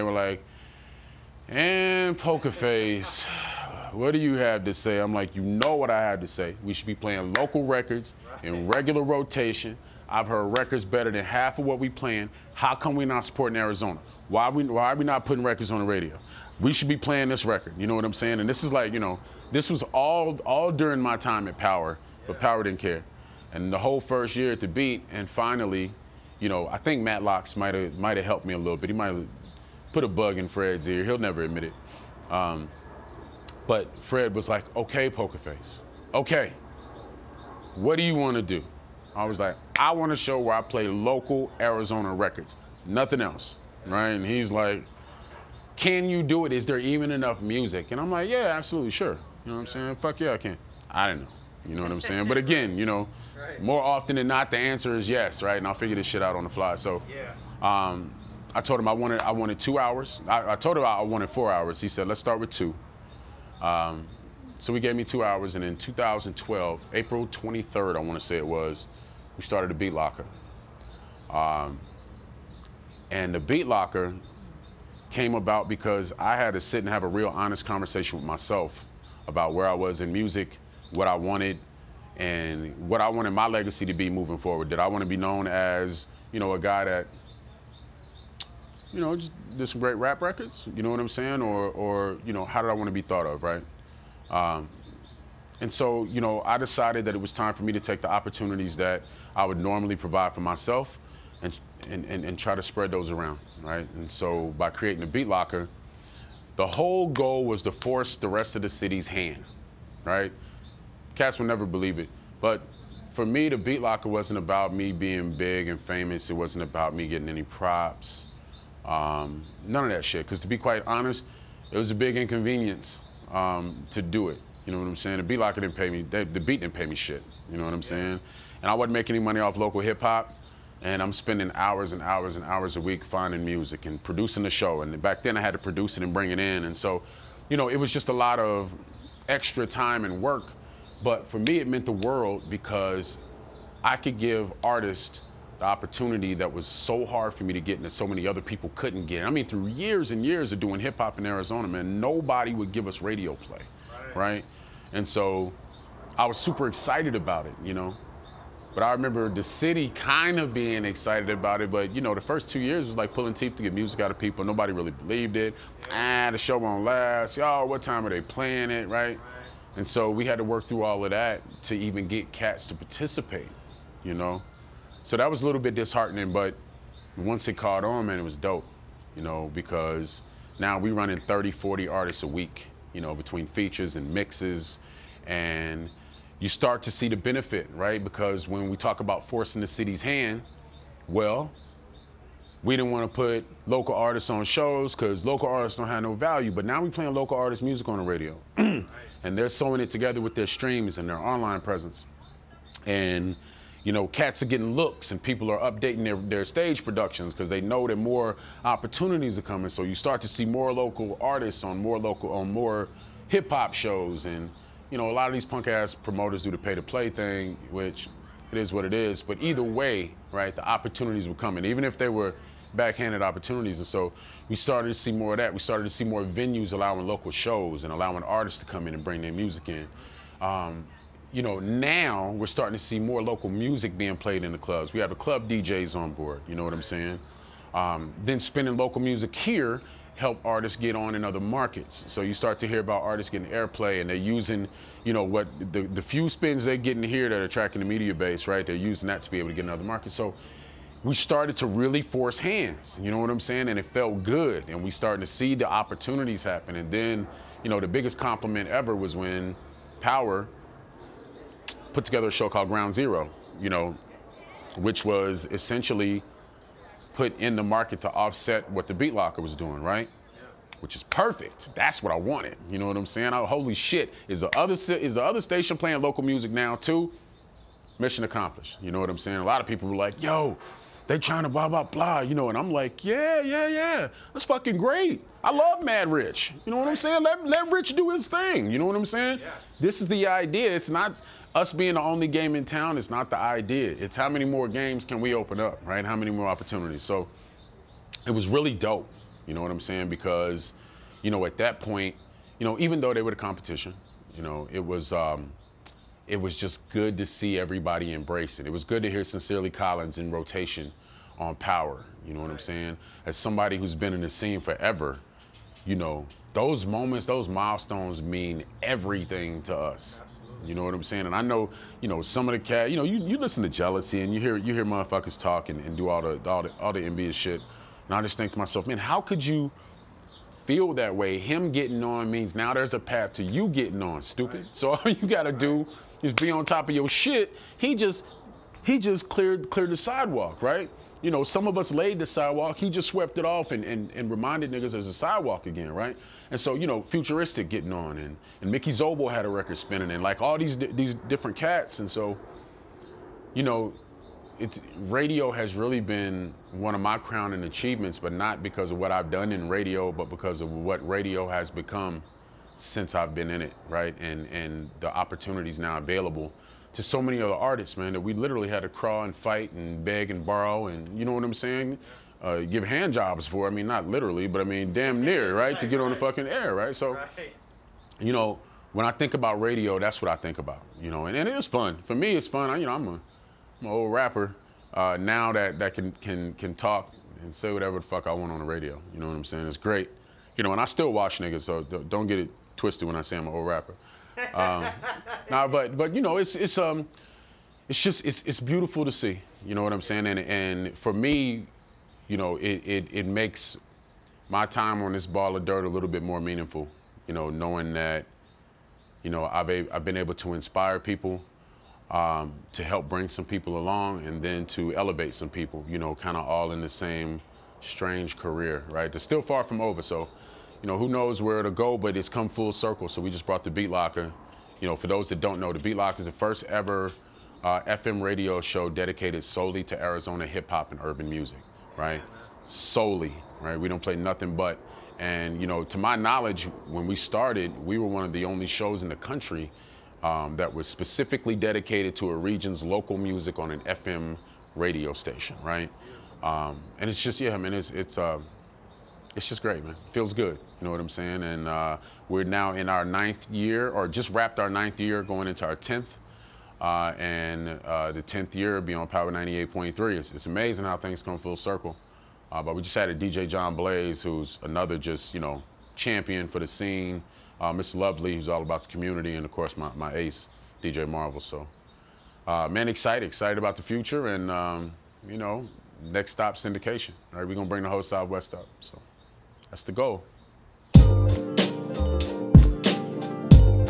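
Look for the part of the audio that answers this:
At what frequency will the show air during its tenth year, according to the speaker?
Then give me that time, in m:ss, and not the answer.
7:39.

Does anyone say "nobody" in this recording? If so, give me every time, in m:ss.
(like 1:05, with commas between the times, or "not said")
2:32, 2:44.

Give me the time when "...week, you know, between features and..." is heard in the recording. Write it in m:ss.
3:02.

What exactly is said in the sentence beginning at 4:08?
They're using that to be able to get in other markets.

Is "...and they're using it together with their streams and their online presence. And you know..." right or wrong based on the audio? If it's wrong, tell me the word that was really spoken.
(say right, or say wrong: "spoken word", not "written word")
wrong: "sewing", not "using".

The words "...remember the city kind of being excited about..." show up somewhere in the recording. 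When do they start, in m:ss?
2:38.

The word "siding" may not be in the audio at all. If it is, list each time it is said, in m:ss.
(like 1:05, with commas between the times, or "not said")
not said.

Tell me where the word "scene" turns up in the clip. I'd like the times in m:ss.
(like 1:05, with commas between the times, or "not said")
5:14, 7:46.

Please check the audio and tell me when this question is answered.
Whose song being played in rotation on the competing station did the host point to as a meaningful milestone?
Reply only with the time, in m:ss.
5:09.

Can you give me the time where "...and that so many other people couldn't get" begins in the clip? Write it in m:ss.
2:27.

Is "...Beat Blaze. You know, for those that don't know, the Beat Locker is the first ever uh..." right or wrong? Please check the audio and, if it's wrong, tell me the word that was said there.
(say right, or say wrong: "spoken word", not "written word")
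wrong: "Locker", not "Blaze".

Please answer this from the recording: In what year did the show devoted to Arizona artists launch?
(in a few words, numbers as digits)
2012.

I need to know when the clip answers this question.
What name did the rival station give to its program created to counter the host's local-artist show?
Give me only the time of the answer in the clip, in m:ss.
4:22.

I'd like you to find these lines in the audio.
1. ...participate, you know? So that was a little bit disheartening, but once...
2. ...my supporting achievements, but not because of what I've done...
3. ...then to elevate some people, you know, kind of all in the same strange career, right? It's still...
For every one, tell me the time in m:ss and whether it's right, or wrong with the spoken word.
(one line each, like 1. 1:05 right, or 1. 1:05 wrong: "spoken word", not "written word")
1. 2:52 right
2. 5:57 wrong: "crowning", not "supporting"
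3. 6:54 right.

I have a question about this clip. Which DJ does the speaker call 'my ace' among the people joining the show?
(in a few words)
DJ Marvel.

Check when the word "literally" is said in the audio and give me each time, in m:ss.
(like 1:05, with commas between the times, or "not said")
6:08, 6:14.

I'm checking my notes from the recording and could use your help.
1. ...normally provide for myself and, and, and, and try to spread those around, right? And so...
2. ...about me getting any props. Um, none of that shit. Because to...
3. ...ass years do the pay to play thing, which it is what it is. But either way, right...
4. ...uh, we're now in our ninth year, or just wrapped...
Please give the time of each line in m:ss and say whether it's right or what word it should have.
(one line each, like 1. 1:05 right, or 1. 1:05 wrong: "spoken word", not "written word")
1. 1:39 right
2. 1:56 right
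3. 3:35 wrong: "promoters", not "years"
4. 7:31 right.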